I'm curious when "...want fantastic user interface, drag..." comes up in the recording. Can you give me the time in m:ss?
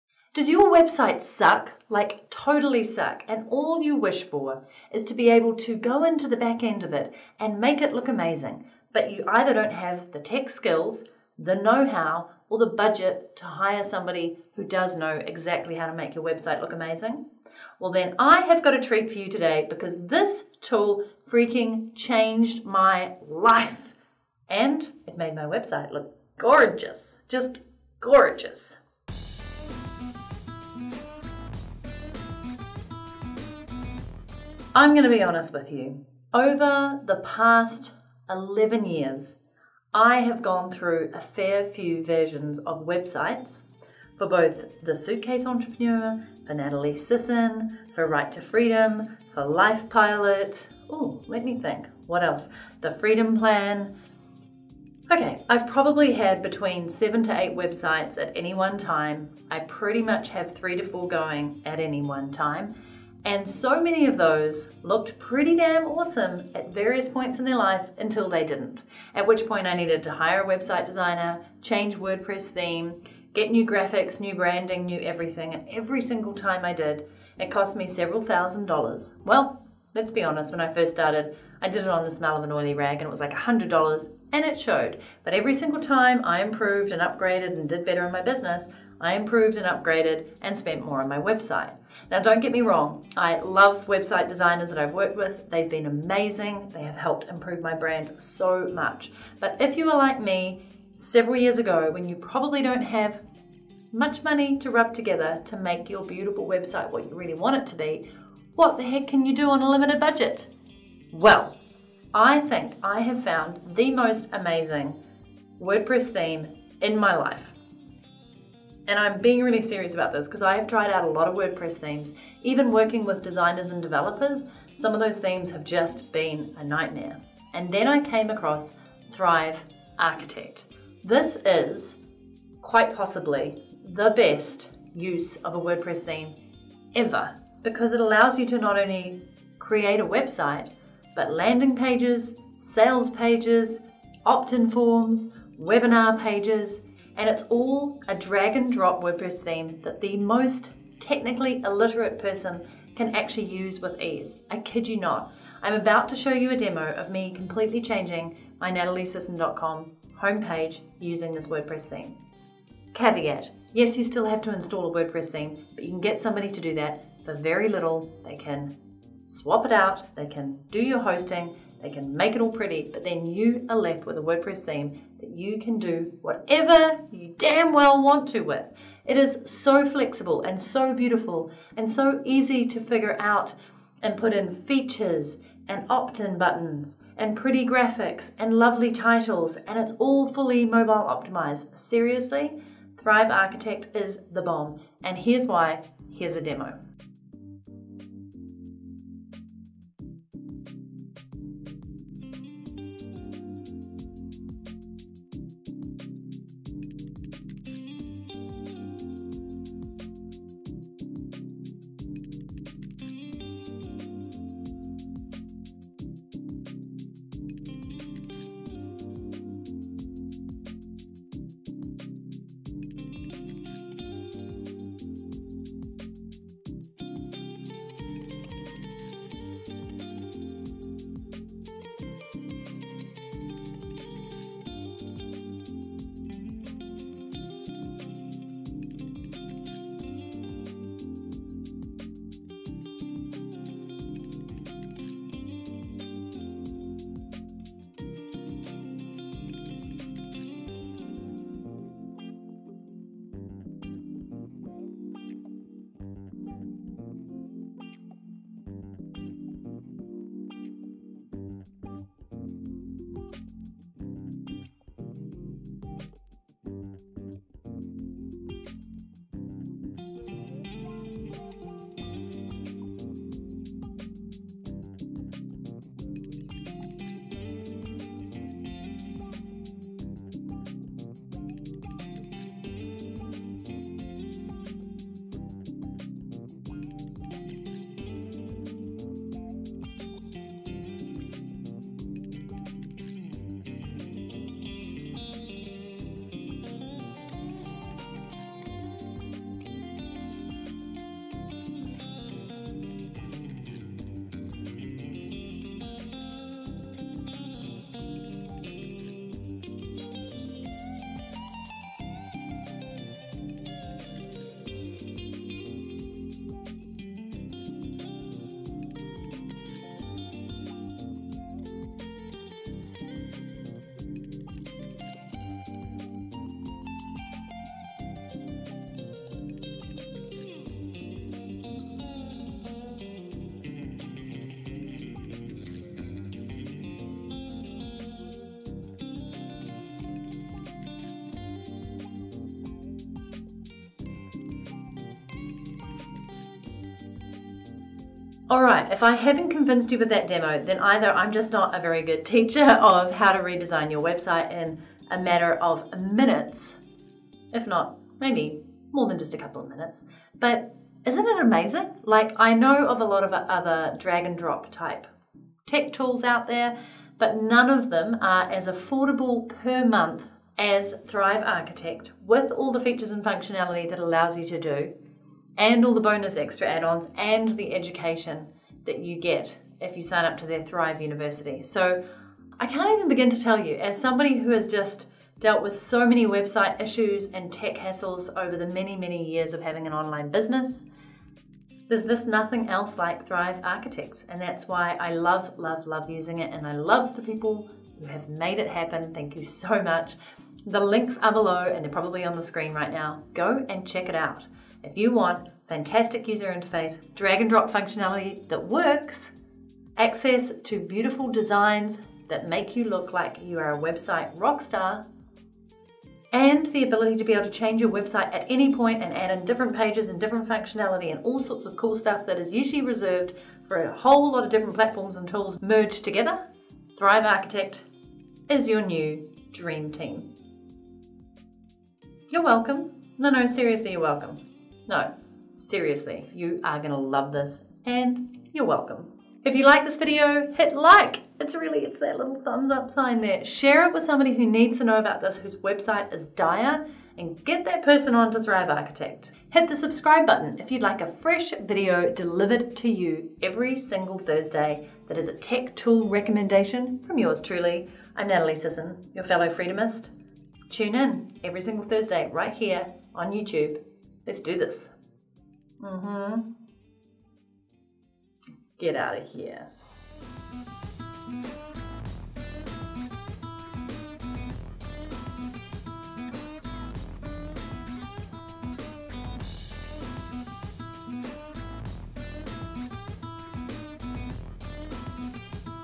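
6:45.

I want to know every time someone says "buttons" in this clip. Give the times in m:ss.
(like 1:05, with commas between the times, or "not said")
3:06, 7:30.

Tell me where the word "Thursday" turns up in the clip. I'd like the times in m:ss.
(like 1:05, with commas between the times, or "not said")
7:34, 7:41.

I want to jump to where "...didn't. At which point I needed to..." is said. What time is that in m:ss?
1:08.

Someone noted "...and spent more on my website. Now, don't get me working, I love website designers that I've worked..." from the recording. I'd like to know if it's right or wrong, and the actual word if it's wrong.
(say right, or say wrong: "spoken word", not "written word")
wrong: "wrong", not "working".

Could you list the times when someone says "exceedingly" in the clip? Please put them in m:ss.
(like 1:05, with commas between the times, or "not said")
not said.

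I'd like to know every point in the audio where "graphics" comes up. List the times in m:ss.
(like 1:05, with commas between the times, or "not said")
1:13, 3:07.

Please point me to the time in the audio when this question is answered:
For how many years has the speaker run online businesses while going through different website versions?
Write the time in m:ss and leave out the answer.
0:38.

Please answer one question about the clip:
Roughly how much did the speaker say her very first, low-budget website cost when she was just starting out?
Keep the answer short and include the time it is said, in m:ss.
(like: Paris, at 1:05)
$100, at 1:23.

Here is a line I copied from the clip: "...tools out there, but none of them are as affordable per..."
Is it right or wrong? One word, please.
right.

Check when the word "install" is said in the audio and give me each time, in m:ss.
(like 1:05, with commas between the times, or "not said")
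2:44.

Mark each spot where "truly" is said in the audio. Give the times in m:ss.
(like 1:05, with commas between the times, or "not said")
7:37.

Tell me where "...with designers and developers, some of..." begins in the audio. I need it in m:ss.
2:03.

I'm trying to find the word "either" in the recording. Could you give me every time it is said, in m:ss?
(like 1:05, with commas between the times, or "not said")
0:09, 5:50.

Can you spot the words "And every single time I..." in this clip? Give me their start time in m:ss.
1:15.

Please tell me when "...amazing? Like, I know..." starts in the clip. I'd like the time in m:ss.
6:01.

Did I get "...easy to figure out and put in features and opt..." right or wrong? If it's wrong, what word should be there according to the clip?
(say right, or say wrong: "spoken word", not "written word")
right.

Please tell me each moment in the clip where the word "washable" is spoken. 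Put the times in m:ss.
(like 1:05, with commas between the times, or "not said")
not said.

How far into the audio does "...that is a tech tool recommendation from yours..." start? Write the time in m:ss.
7:35.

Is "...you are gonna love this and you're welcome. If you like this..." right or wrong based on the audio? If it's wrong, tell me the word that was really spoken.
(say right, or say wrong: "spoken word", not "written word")
right.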